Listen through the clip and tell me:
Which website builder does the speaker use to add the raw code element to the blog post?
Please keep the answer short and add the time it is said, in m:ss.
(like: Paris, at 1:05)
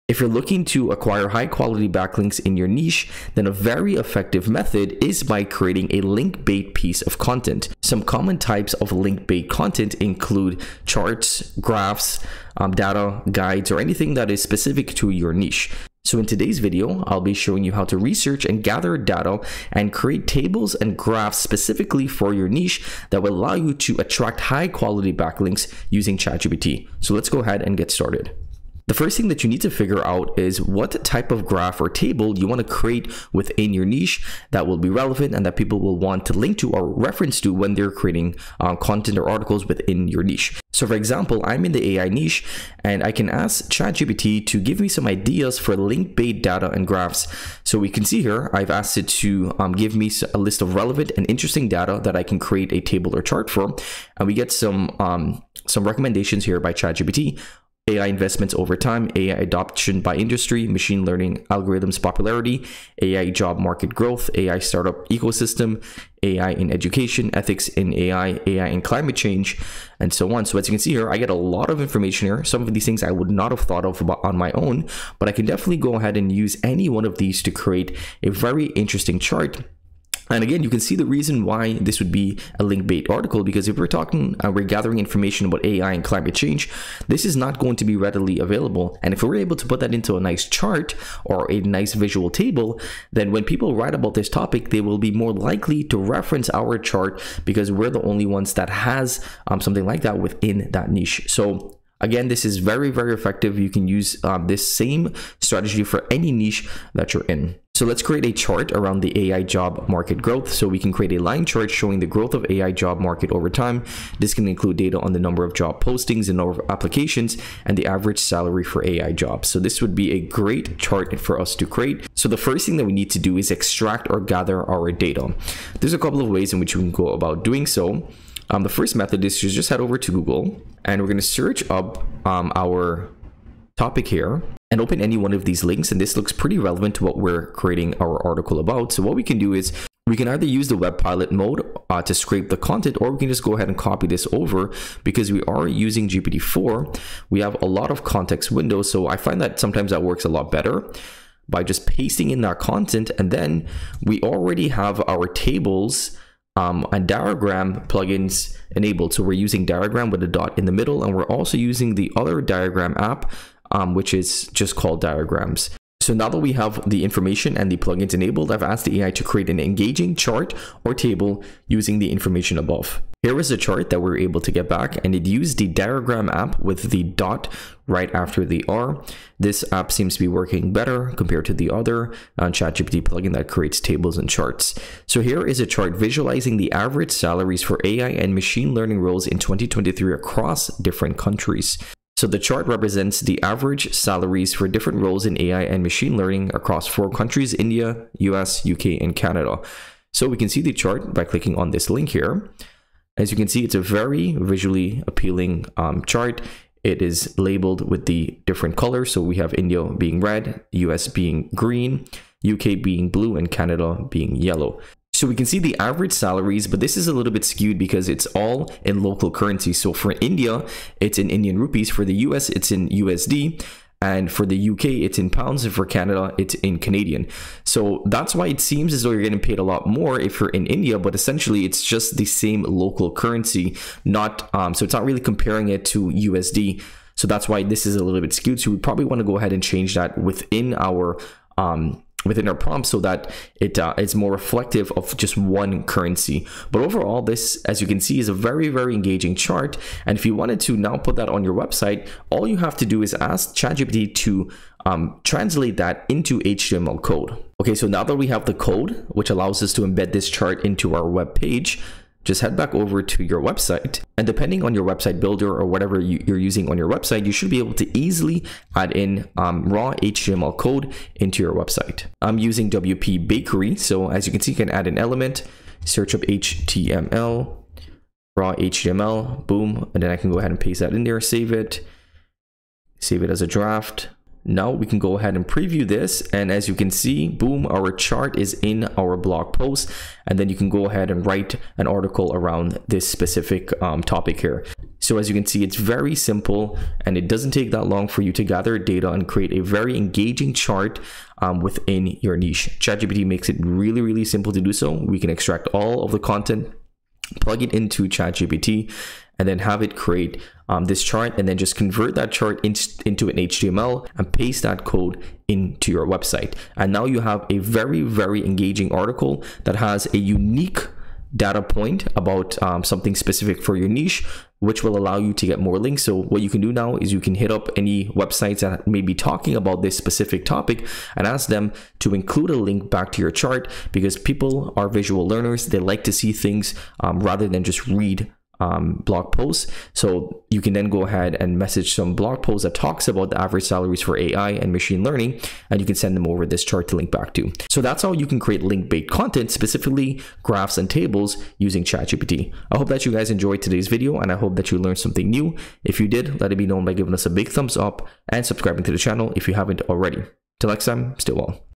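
WPBakery, at 4:32.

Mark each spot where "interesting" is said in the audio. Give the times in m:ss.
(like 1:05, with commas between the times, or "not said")
0:51, 1:18.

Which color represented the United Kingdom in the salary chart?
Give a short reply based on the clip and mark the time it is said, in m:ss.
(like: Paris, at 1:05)
Blue, at 3:33.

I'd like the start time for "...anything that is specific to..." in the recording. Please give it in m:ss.
0:13.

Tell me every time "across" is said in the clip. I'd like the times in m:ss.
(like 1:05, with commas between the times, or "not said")
3:10, 3:16.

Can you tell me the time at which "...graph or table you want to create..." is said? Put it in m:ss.
0:31.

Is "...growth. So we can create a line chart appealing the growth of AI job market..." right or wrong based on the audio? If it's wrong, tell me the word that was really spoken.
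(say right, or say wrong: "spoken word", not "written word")
wrong: "showing", not "appealing".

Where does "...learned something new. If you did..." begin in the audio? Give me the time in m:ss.
5:54.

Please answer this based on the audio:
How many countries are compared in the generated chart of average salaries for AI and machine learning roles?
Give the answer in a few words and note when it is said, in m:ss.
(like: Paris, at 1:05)
4, at 3:16.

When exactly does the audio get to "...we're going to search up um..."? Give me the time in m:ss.
2:11.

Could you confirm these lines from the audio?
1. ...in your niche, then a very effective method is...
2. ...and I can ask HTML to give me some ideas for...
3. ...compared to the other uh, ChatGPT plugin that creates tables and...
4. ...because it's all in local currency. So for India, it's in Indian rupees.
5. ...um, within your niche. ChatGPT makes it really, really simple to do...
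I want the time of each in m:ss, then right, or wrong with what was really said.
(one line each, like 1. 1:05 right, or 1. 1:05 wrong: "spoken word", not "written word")
1. 0:02 right
2. 0:42 wrong: "ChatGPT", not "HTML"
3. 3:01 right
4. 3:37 right
5. 5:01 right.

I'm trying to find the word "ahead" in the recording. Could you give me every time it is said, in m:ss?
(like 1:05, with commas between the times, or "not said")
0:27, 1:15, 2:23, 3:59, 4:40, 4:45, 4:50, 5:41.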